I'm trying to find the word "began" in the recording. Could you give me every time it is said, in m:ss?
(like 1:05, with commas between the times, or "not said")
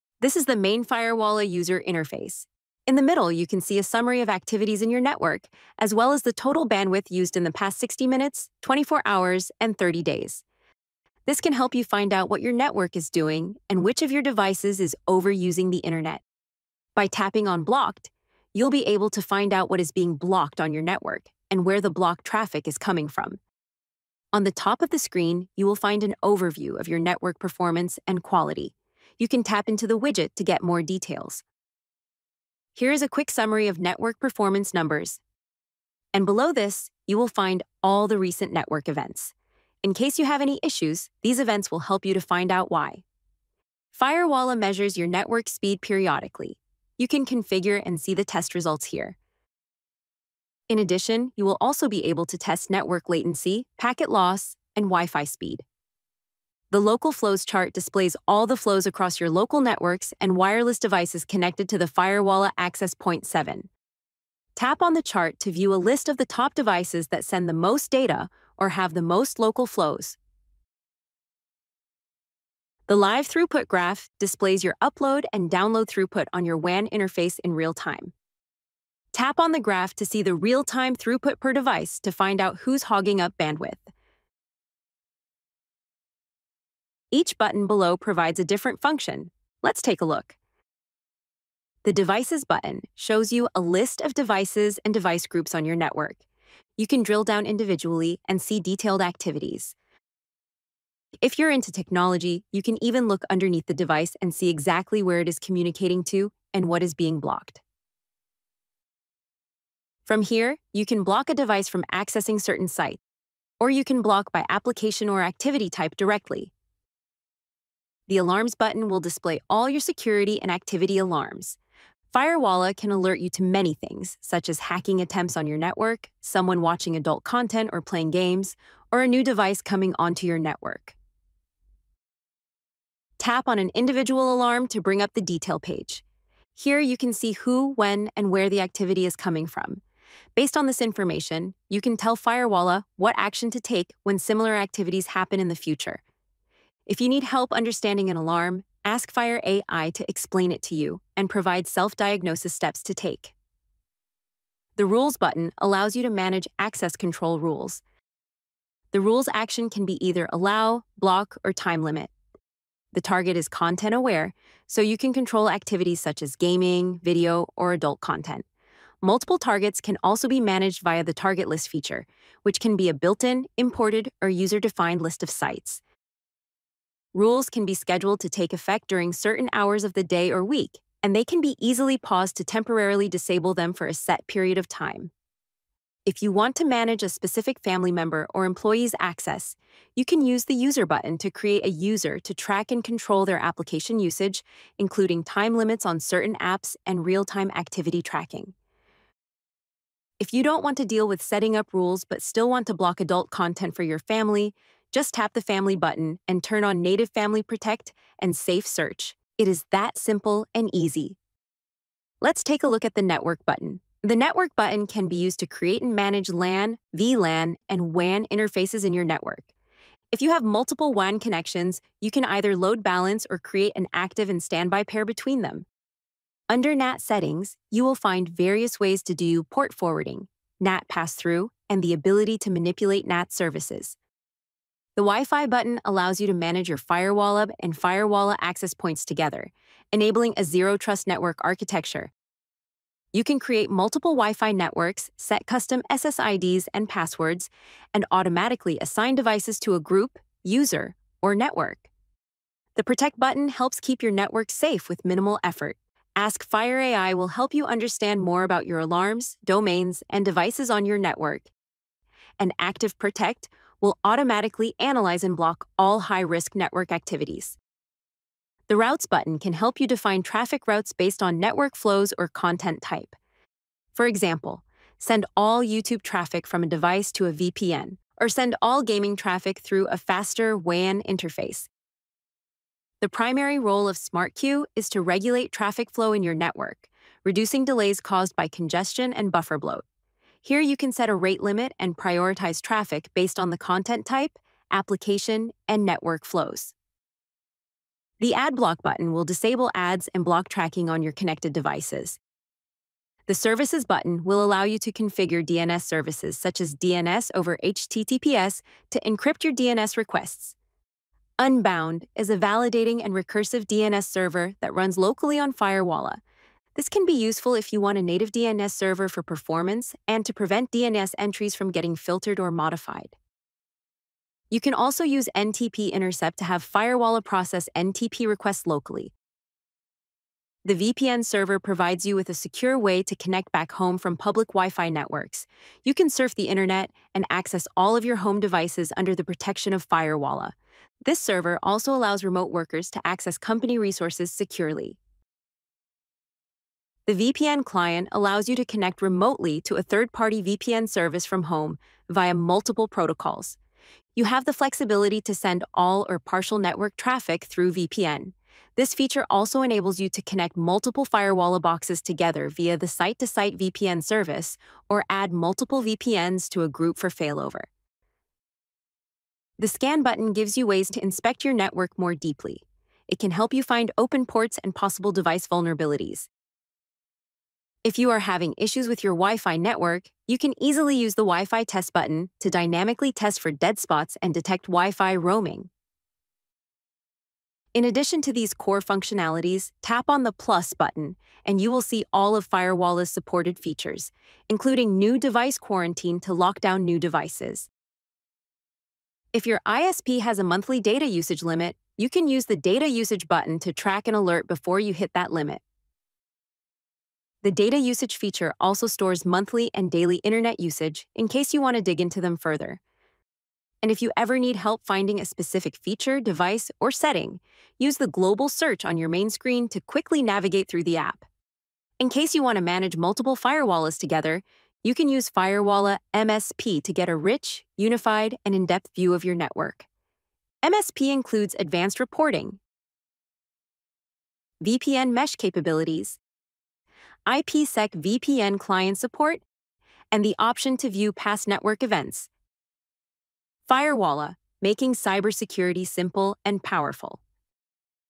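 not said.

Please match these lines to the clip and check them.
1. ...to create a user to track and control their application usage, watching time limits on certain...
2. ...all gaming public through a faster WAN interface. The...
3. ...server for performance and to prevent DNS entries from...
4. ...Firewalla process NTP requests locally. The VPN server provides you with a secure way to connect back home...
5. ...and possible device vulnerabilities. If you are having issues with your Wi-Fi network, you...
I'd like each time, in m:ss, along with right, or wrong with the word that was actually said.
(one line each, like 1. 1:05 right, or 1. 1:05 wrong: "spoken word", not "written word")
1. 3:11 wrong: "including", not "watching"
2. 4:38 wrong: "traffic", not "public"
3. 5:18 right
4. 5:26 right
5. 6:14 right.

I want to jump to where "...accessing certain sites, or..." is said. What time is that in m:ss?
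1:51.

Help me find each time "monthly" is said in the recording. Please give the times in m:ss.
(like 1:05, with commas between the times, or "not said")
6:40, 6:49.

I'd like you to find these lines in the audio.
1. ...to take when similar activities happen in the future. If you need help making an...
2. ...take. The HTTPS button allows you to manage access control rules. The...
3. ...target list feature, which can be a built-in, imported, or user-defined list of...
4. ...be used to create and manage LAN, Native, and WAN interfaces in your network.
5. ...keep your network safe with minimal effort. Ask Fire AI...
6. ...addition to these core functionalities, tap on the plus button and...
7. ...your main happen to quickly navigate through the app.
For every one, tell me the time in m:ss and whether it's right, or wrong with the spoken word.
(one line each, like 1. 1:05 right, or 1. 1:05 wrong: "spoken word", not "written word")
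1. 2:23 wrong: "understanding", not "making"
2. 2:32 wrong: "Rules", not "HTTPS"
3. 2:51 right
4. 3:35 wrong: "VLAN", not "Native"
5. 4:13 right
6. 6:27 right
7. 6:58 wrong: "screen", not "happen".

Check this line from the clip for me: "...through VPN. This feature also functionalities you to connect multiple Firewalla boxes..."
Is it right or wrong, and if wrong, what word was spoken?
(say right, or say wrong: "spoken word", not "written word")
wrong: "enables", not "functionalities".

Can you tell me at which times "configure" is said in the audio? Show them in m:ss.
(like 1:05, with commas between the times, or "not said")
0:47, 5:04.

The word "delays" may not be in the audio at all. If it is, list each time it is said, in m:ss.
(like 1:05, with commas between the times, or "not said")
4:47.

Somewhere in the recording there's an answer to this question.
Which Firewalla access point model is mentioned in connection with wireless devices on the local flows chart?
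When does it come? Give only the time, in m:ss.
1:02.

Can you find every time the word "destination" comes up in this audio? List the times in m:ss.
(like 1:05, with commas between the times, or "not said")
not said.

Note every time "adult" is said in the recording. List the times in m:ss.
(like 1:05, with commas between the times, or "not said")
2:06, 2:47, 3:23.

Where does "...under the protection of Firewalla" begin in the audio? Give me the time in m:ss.
5:38.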